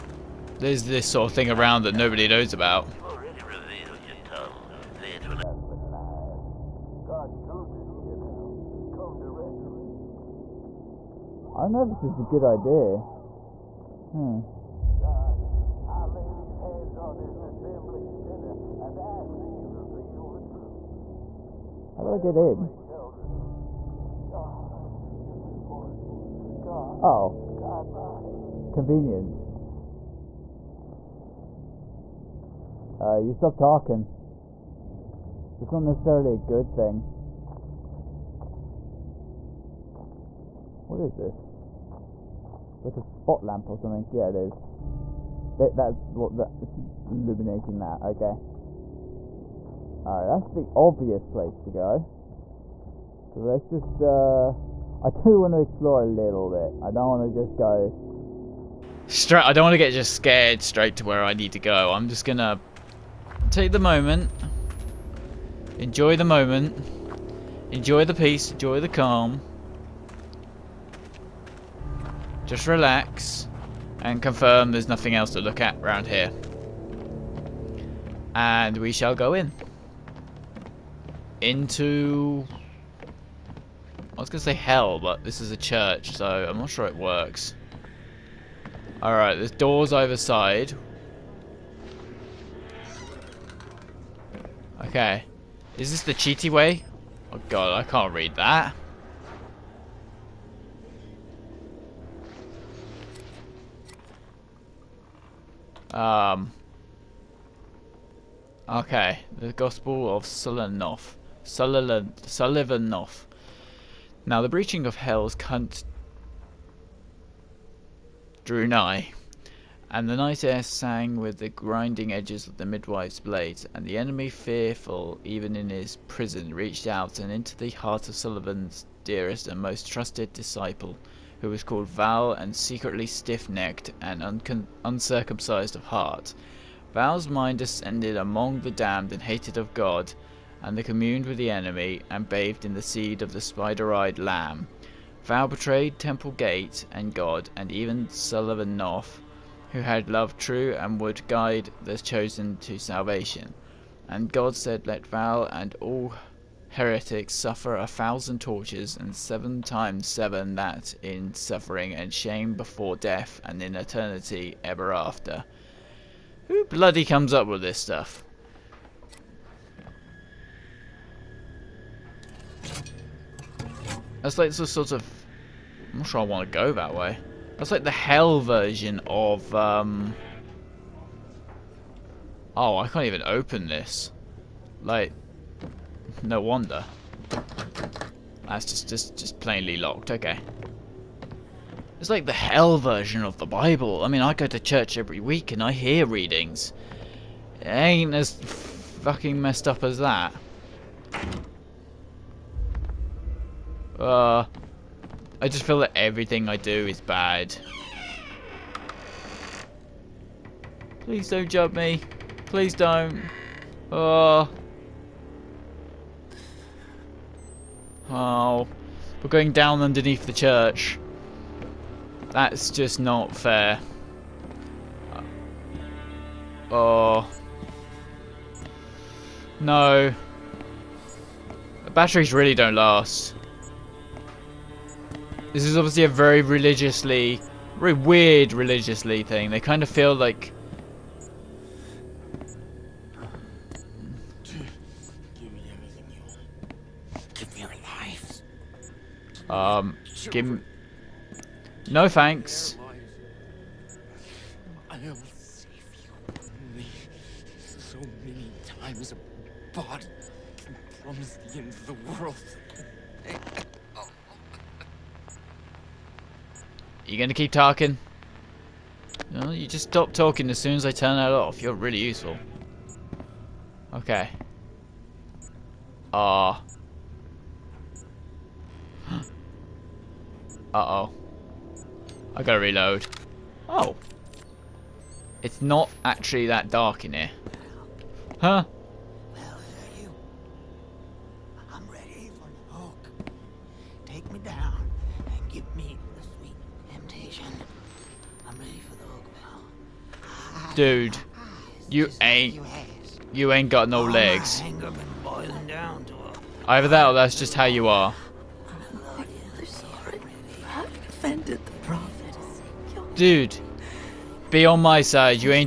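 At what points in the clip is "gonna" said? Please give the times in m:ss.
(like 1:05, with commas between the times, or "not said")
1:02, 4:27.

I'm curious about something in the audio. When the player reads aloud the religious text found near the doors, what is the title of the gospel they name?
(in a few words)
Gospel of Sullivanoff.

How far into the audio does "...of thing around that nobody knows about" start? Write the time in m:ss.
0:01.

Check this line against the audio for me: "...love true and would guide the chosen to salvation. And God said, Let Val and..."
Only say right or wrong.
right.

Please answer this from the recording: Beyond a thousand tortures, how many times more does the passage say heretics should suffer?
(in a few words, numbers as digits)
seven times seven.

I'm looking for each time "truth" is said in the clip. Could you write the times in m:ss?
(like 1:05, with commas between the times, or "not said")
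0:07, 0:20.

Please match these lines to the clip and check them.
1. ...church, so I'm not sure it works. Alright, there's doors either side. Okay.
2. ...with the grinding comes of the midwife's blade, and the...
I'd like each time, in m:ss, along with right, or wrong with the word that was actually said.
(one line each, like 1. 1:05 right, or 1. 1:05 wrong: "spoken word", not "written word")
1. 1:25 right
2. 2:01 wrong: "edges", not "comes".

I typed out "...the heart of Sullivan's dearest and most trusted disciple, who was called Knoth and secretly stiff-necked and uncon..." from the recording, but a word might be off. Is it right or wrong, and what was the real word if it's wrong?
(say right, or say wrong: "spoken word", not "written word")
wrong: "Val", not "Knoth".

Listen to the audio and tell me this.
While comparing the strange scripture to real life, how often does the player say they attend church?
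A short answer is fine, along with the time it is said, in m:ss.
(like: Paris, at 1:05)
every week, at 3:14.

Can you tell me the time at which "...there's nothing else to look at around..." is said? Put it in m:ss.
1:14.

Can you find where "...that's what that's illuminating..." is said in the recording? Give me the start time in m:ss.
0:45.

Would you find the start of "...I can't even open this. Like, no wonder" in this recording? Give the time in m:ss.
3:02.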